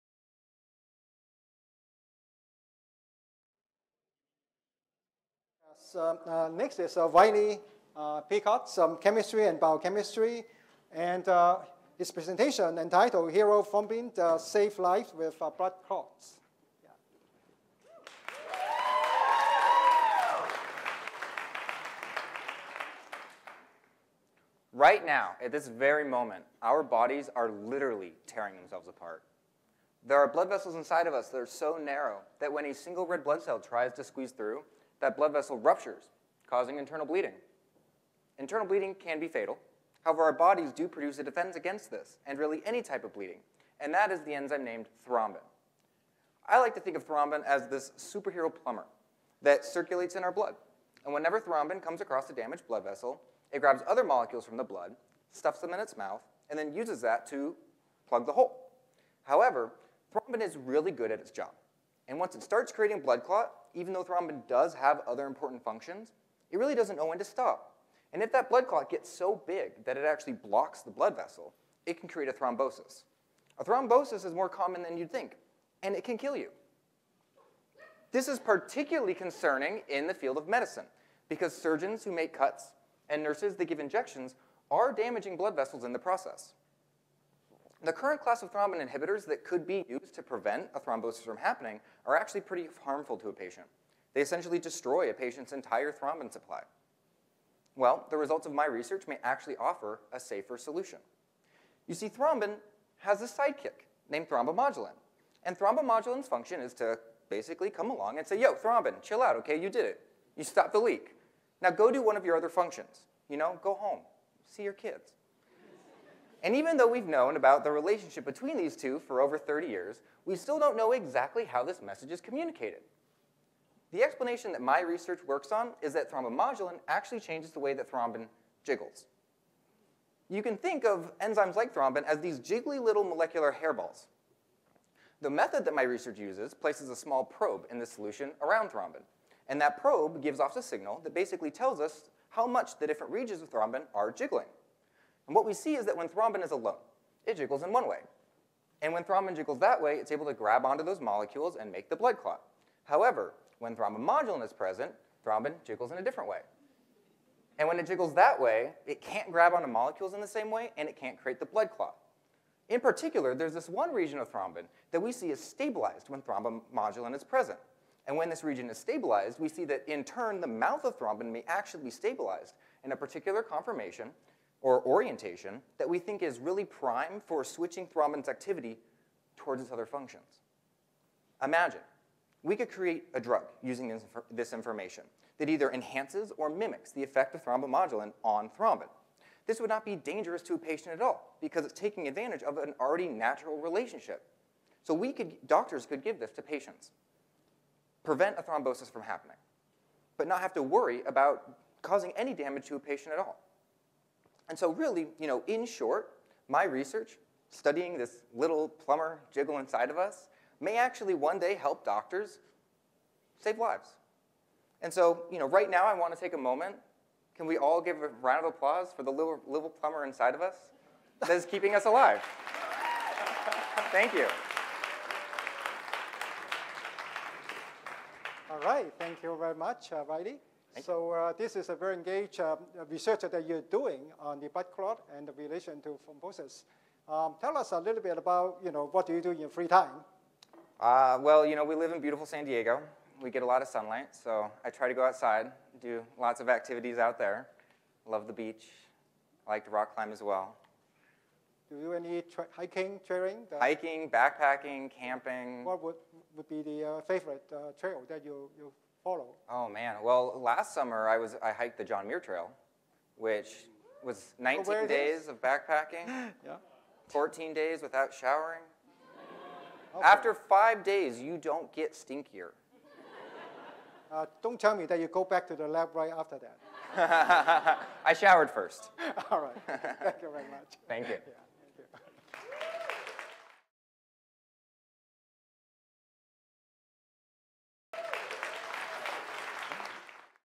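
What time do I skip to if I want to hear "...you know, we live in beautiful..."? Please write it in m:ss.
4:01.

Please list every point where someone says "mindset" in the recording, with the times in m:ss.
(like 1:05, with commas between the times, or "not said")
not said.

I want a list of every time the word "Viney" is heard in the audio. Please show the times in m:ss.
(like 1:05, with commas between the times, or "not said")
0:07.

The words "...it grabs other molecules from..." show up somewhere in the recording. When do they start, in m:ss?
0:53.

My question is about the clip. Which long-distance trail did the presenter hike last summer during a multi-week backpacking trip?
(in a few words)
John Muir Trail.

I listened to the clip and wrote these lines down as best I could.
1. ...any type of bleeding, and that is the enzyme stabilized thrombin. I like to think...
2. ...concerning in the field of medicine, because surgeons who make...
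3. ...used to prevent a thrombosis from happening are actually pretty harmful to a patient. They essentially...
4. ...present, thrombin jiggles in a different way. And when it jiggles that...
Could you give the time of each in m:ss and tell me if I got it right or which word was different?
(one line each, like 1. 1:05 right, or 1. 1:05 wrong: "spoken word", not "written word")
1. 0:42 wrong: "named", not "stabilized"
2. 1:19 right
3. 1:29 right
4. 2:34 right.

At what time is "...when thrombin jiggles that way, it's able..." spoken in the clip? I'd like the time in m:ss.
2:28.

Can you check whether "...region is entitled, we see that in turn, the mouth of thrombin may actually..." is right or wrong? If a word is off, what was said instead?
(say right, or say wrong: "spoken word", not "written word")
wrong: "stabilized", not "entitled".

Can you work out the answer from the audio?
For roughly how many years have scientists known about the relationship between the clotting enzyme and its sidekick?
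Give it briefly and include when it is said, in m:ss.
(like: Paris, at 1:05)
over 30 years, at 1:59.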